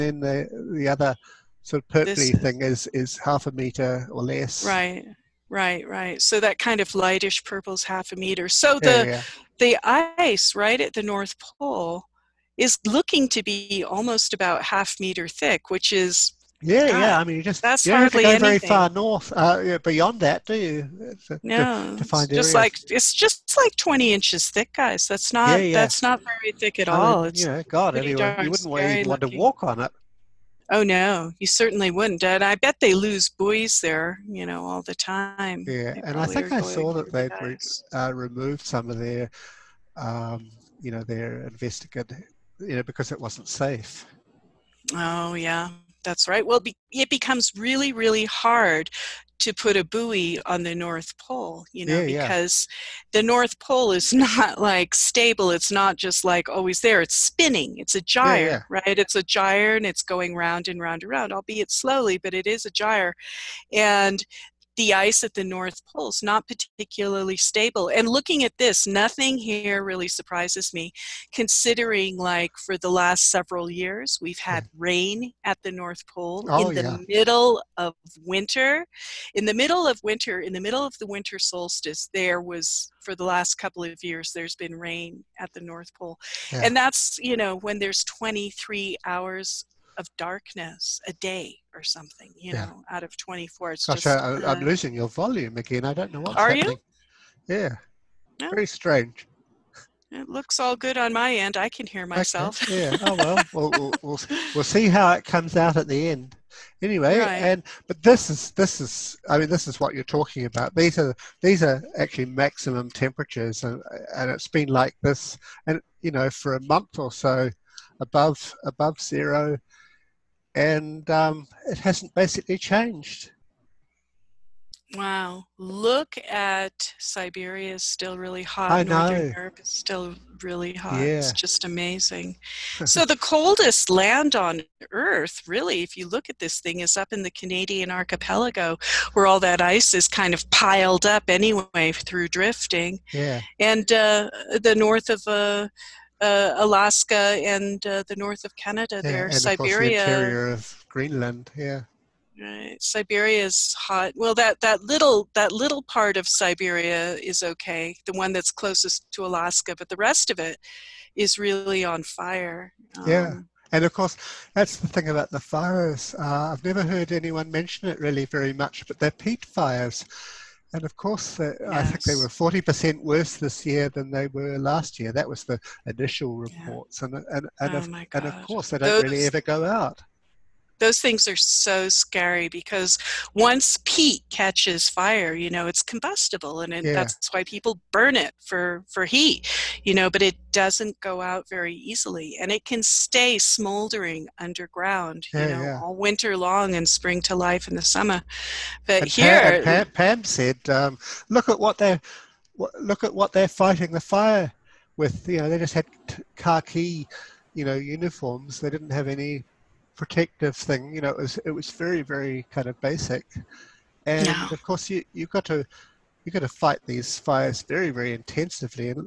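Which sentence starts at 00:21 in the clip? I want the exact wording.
Uh, to, no, to, to just like it's just like twenty inches thick, guys.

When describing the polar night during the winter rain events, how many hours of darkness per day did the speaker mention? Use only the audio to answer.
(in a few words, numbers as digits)
23 hours.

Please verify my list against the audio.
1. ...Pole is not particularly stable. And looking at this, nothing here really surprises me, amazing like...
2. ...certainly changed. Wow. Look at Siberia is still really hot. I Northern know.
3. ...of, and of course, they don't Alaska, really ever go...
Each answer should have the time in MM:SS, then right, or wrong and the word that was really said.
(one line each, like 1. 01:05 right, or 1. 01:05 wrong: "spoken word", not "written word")
1. 01:05 wrong: "considering", not "amazing"
2. 02:02 wrong: "basically", not "certainly"
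3. 02:57 wrong: "Those", not "Alaska".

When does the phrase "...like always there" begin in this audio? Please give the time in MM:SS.
00:56.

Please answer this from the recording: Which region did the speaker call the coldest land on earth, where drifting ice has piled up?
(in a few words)
Canadian archipelago.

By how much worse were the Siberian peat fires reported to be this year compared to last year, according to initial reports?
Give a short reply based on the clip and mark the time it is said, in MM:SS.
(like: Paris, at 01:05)
40%, at 02:52.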